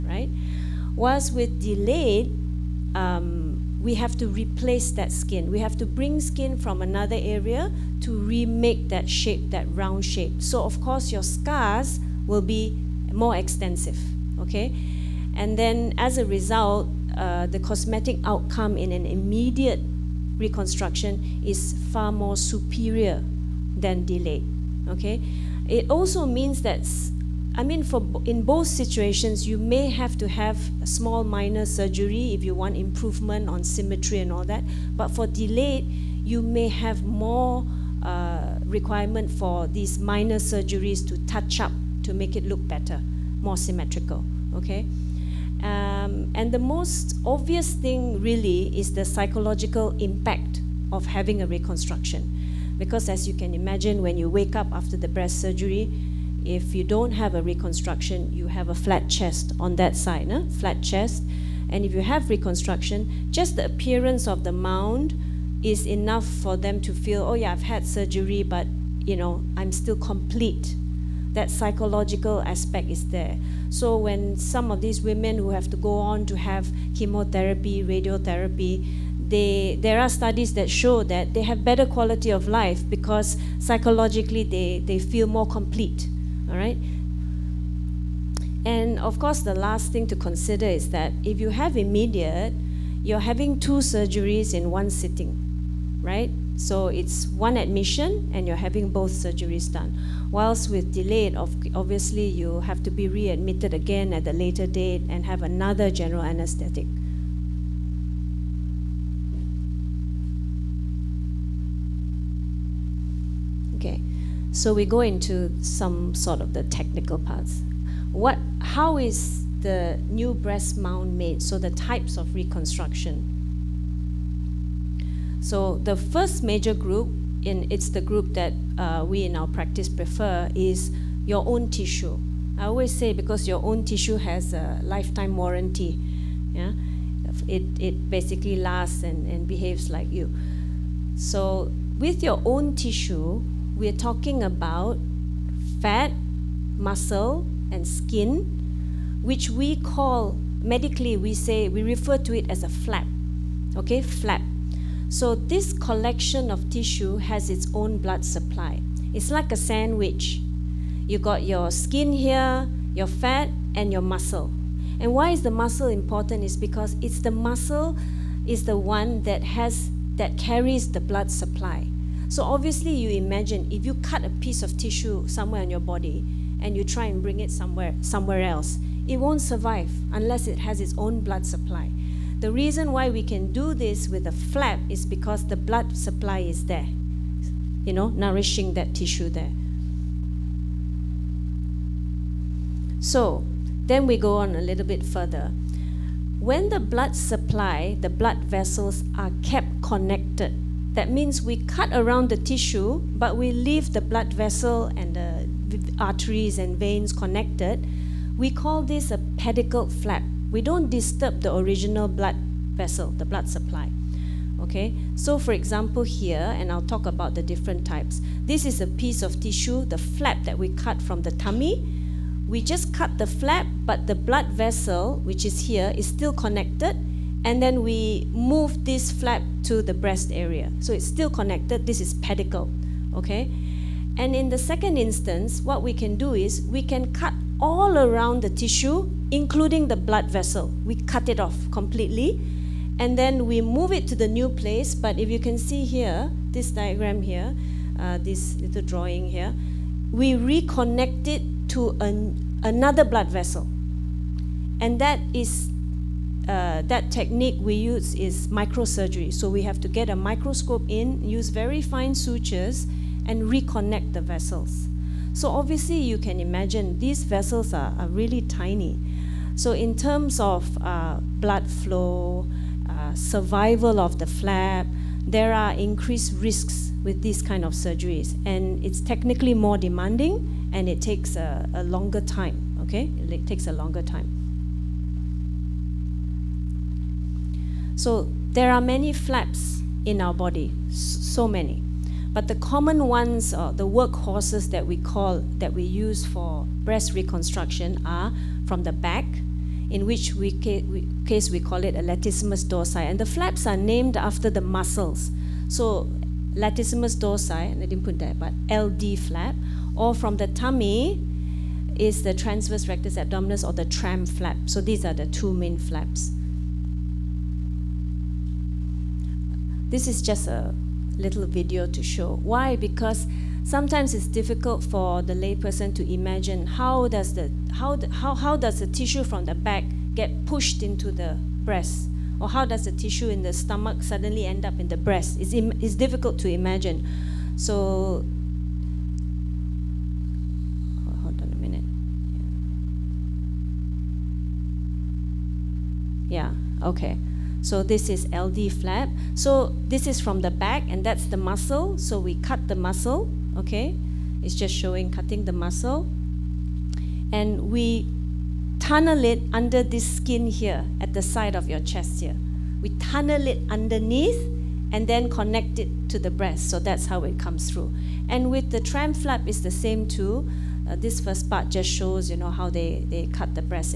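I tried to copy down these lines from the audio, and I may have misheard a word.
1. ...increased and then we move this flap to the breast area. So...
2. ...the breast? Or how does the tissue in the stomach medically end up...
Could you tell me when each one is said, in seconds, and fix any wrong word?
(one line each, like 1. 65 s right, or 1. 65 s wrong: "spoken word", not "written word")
1. 226 s wrong: "connected", not "increased"
2. 331 s wrong: "suddenly", not "medically".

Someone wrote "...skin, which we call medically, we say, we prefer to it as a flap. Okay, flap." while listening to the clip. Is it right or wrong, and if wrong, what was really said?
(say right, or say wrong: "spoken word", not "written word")
wrong: "refer", not "prefer".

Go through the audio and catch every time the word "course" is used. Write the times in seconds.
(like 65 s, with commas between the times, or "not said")
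10 s, 89 s.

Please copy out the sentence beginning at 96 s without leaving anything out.
So it's one admission and you're having both surgeries done.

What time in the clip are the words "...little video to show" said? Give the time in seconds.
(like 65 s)
321 s.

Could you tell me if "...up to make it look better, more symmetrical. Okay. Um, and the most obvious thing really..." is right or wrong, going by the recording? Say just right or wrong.
right.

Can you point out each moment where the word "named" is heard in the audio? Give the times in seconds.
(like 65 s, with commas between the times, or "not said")
303 s.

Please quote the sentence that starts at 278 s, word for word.
And it's technically more demanding and it takes a, a longer time, okay?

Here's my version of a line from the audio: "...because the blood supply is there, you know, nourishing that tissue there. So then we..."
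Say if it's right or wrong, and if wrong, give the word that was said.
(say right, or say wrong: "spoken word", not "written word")
right.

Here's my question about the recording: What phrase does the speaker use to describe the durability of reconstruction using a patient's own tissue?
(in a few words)
lifetime warranty.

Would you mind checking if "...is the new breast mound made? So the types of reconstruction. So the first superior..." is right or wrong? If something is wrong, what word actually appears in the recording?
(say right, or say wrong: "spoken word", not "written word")
wrong: "major", not "superior".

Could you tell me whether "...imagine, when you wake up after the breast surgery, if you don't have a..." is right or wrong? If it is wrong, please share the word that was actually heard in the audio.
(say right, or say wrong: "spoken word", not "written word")
right.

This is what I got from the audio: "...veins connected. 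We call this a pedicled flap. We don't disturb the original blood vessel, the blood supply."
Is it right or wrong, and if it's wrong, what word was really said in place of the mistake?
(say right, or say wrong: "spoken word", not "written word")
right.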